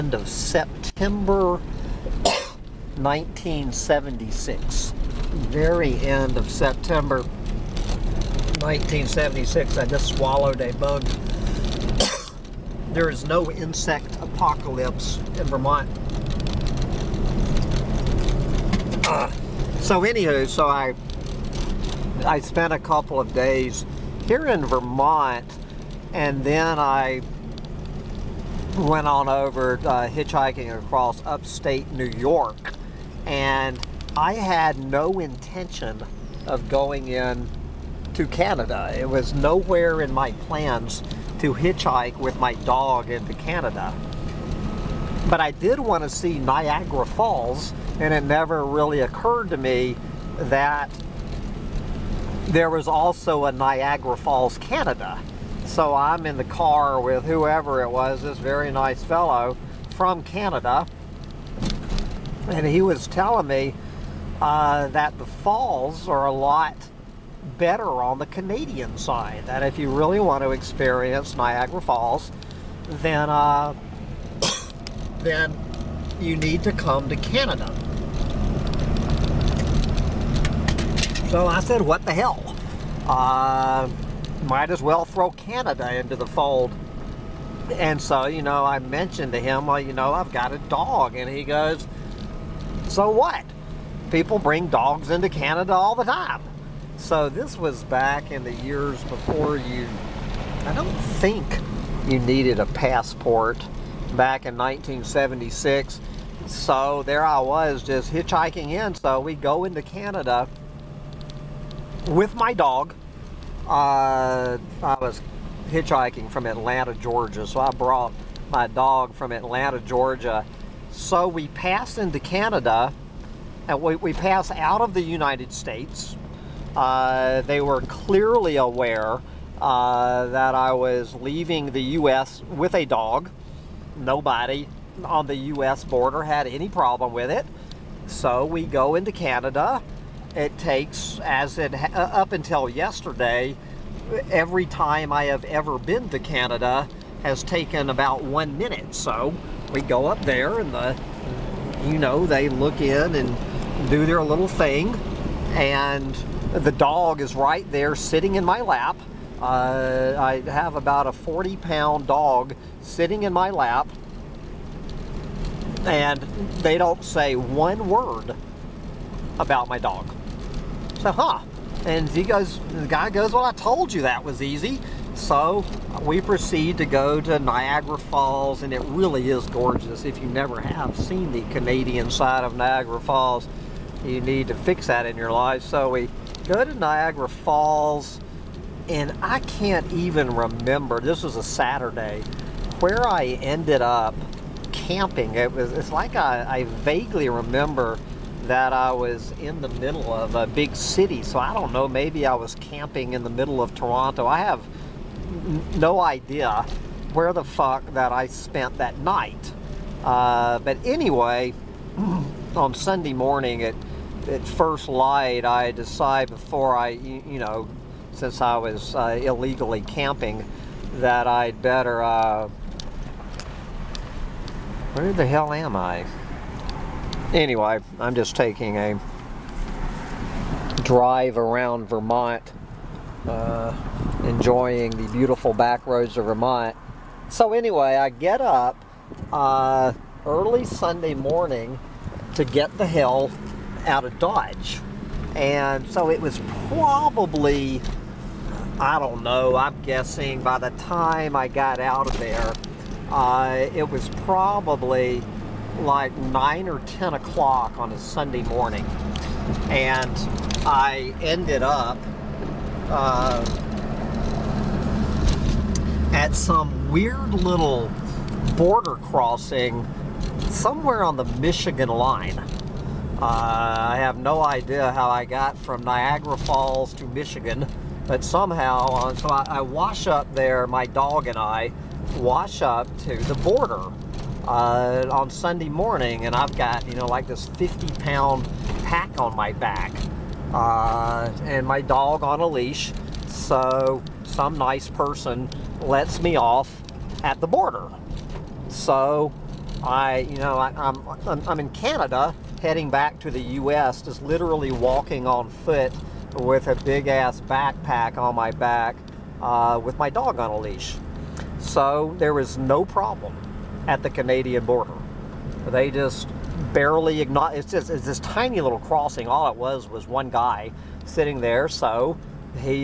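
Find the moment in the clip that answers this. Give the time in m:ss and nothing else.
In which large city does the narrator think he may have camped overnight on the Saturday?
3:23.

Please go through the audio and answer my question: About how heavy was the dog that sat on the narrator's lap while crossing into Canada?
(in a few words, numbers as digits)
40 pounds.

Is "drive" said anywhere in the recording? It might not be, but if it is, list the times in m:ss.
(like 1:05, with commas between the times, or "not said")
3:50.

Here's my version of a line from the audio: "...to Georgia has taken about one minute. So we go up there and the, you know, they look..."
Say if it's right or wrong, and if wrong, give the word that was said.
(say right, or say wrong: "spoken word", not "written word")
wrong: "Canada", not "Georgia".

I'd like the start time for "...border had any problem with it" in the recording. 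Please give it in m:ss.
2:15.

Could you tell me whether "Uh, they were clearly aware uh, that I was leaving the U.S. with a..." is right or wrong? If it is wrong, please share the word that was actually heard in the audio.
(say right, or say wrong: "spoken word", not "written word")
right.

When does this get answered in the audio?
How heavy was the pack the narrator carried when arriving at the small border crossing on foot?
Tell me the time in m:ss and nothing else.
4:47.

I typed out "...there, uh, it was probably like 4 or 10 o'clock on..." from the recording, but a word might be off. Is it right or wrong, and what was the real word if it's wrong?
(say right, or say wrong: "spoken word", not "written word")
wrong: "9", not "4".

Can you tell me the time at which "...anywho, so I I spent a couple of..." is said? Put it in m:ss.
0:20.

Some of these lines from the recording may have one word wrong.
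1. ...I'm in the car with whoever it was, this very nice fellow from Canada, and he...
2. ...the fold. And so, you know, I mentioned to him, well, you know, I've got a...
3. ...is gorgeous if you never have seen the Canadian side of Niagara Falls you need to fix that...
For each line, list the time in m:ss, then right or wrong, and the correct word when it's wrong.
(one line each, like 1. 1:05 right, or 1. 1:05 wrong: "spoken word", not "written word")
1. 0:55 right
2. 1:26 right
3. 2:59 right.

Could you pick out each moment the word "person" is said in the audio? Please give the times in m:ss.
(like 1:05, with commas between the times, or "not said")
4:54.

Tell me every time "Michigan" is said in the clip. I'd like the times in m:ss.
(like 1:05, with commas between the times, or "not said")
4:31, 4:37.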